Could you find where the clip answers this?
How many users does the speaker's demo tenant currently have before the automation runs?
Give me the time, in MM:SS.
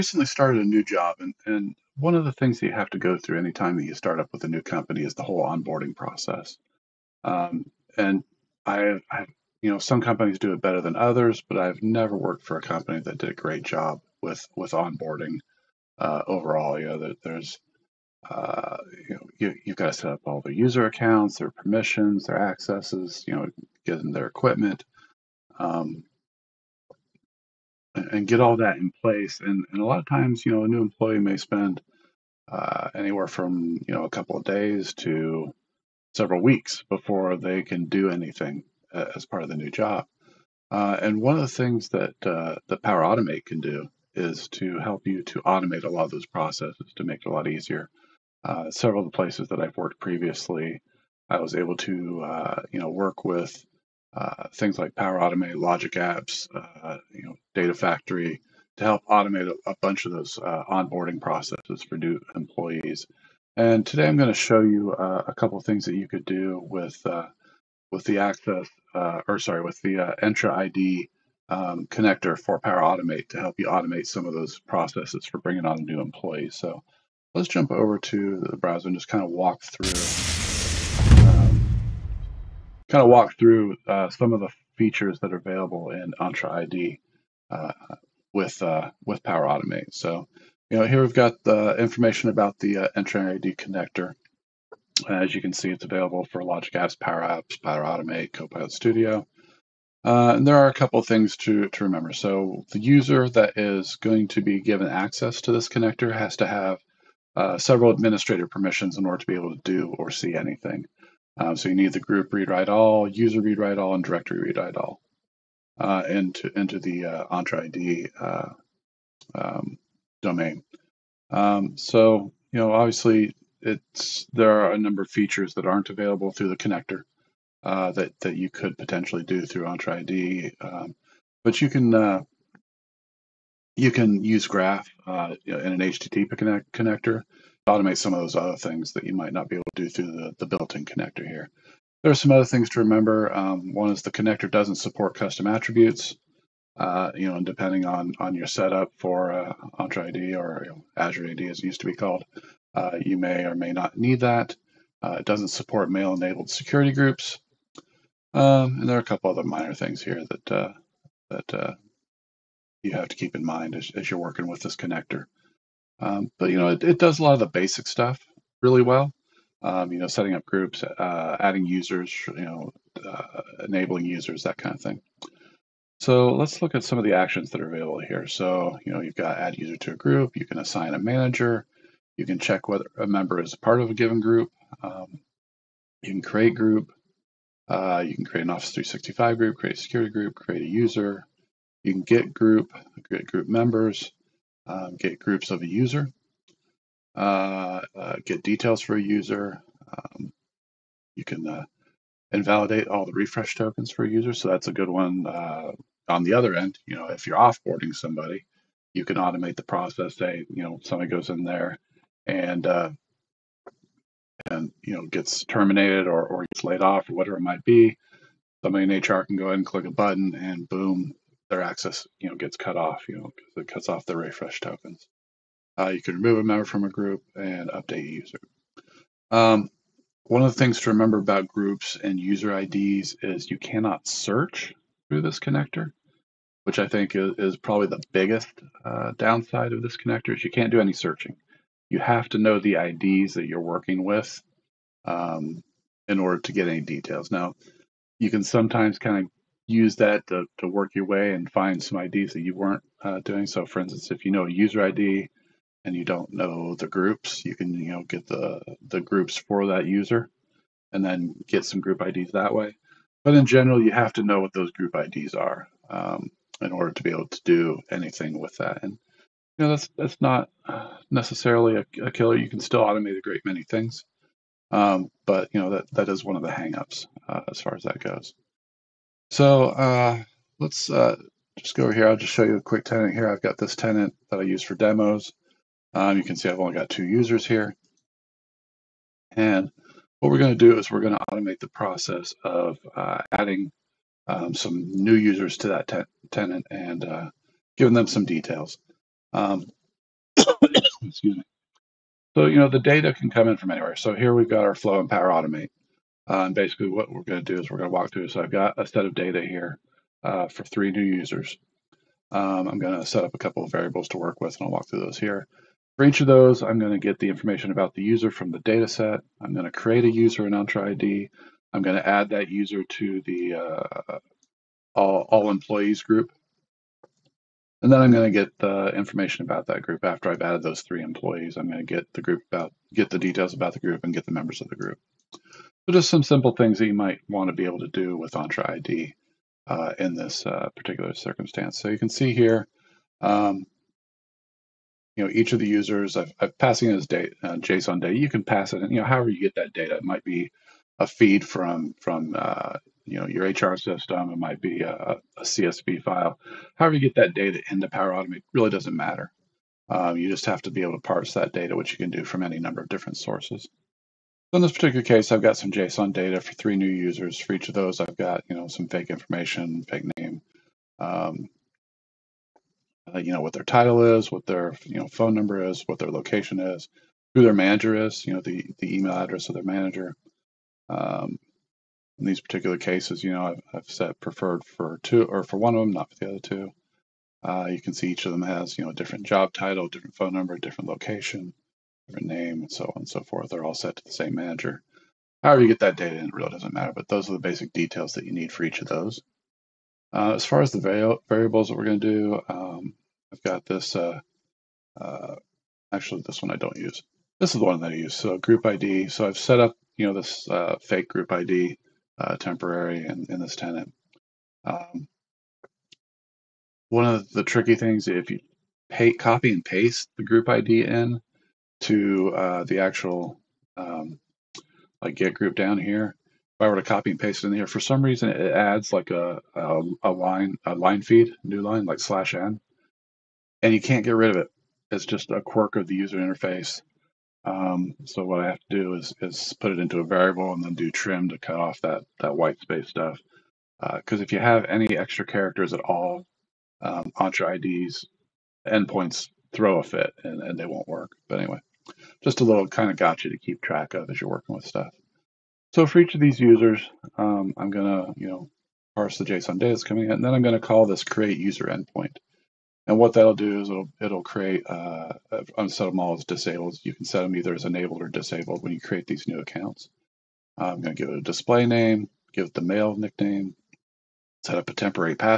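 04:46.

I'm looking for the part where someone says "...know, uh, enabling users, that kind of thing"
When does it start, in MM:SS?
02:52.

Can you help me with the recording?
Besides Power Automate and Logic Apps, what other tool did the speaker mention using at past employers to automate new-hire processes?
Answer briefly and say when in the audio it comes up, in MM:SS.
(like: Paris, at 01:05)
Data Factory, at 00:57.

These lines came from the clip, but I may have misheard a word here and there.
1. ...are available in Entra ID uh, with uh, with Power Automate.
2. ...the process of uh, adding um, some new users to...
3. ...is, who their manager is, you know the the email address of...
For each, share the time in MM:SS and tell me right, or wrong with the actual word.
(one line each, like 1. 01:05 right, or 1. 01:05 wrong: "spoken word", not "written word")
1. 01:25 right
2. 04:51 right
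3. 06:16 right.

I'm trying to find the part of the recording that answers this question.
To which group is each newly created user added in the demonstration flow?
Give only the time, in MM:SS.
05:25.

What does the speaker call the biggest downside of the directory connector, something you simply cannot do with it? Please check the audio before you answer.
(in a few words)
searching.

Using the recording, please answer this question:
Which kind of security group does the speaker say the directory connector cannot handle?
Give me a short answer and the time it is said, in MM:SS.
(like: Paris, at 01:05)
mail-enabled security groups, at 02:35.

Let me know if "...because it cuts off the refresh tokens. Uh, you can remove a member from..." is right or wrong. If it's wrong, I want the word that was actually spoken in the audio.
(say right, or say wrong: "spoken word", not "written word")
right.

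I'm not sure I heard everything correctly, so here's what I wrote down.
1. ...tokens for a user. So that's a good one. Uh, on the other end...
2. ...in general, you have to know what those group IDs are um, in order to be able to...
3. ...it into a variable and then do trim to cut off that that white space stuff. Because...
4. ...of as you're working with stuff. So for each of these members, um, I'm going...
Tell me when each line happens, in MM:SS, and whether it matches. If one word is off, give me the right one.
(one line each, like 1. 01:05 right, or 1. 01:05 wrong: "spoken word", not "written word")
1. 03:23 right
2. 04:23 right
3. 07:19 right
4. 07:33 wrong: "users", not "members".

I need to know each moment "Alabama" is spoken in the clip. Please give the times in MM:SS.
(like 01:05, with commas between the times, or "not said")
not said.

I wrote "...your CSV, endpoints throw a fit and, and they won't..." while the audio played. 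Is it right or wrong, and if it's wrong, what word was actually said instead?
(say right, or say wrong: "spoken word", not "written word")
wrong: "IDs", not "CSV".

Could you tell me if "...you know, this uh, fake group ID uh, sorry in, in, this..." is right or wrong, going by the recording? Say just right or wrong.
wrong.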